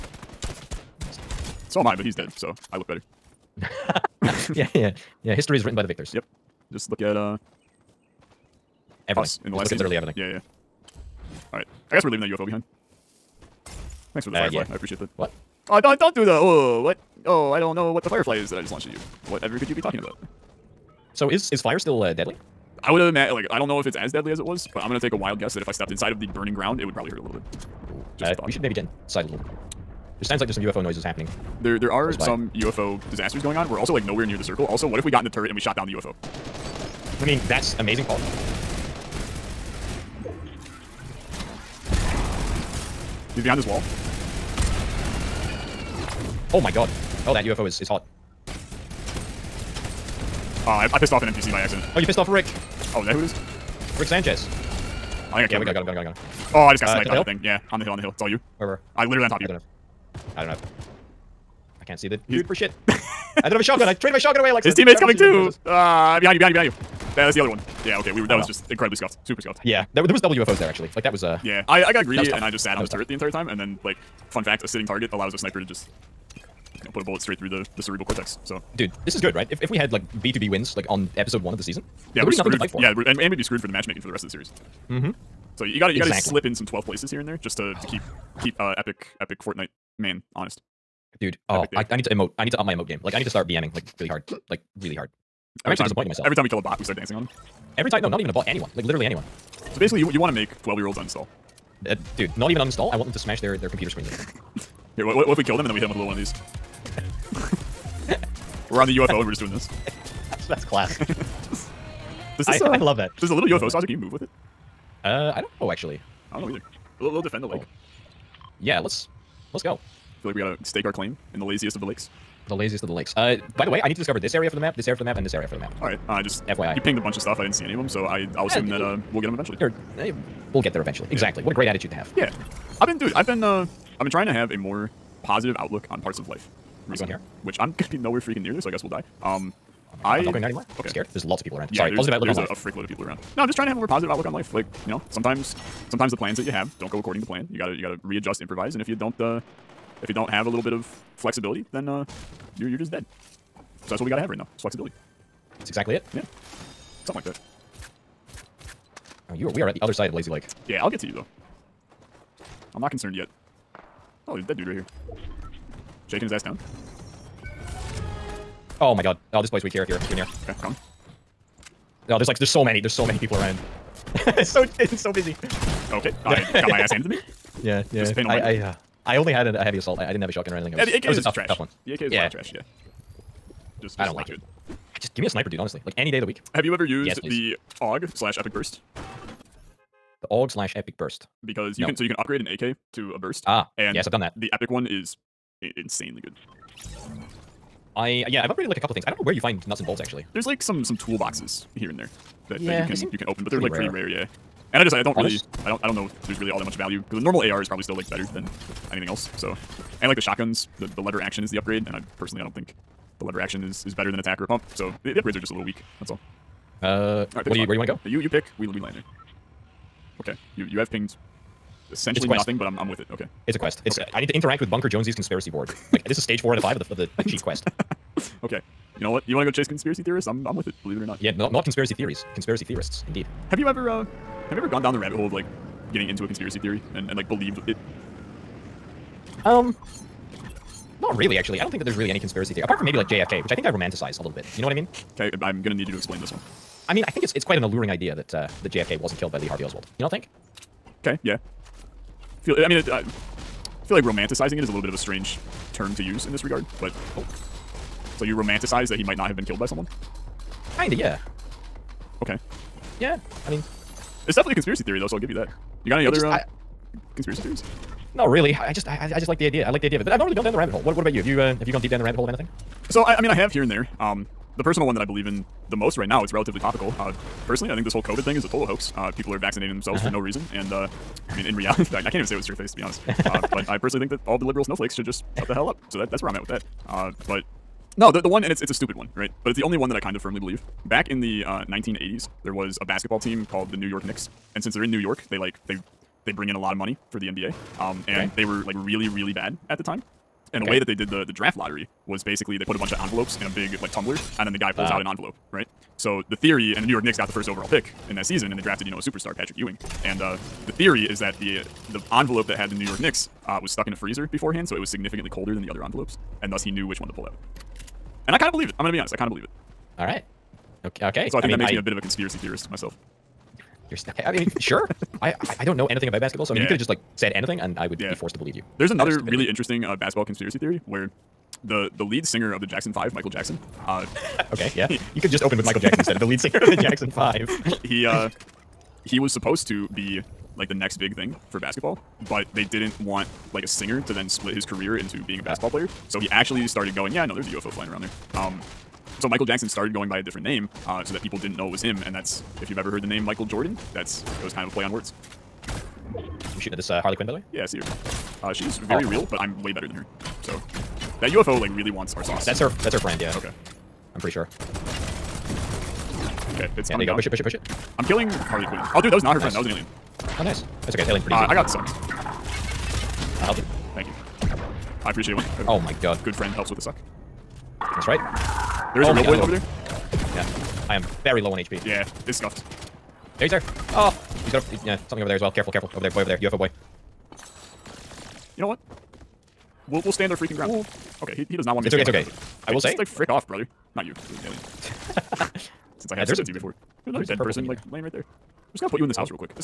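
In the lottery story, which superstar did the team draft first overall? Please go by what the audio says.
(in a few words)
Patrick Ewing.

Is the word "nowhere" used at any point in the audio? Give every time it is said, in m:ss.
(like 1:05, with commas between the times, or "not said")
0:34, 2:17.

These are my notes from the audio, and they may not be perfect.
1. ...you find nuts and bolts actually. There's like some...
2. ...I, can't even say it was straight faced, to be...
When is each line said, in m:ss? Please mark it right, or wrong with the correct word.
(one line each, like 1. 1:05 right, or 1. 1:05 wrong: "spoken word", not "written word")
1. 3:19 right
2. 4:41 right.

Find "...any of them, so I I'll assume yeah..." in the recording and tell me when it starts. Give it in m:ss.
2:07.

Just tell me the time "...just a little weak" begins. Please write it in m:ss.
3:35.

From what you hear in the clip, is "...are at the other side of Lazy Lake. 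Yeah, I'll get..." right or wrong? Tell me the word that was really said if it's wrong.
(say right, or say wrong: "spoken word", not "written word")
right.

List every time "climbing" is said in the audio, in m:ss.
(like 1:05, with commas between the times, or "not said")
not said.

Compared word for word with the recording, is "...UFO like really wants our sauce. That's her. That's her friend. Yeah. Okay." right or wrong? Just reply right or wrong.
right.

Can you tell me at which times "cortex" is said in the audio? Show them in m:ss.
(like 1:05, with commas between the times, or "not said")
1:18.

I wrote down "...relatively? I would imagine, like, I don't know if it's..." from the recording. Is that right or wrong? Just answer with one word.
wrong.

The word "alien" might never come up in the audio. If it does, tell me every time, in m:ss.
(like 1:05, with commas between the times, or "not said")
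6:09, 6:34.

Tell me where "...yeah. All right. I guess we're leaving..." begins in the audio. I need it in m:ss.
0:10.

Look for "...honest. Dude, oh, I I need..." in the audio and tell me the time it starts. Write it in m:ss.
1:30.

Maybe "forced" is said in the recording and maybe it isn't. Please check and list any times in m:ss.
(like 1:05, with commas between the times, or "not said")
5:28.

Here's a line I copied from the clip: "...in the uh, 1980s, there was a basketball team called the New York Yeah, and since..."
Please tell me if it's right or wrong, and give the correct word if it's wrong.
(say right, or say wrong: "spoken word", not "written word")
wrong: "Knicks", not "Yeah".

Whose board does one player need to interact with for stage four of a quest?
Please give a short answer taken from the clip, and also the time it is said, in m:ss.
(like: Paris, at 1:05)
Bunker Jonesy, at 3:44.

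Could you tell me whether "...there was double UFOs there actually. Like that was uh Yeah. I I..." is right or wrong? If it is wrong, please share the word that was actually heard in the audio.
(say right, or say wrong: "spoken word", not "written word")
right.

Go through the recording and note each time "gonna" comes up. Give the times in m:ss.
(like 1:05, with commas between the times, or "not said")
0:24, 2:17, 4:05, 5:18, 6:38.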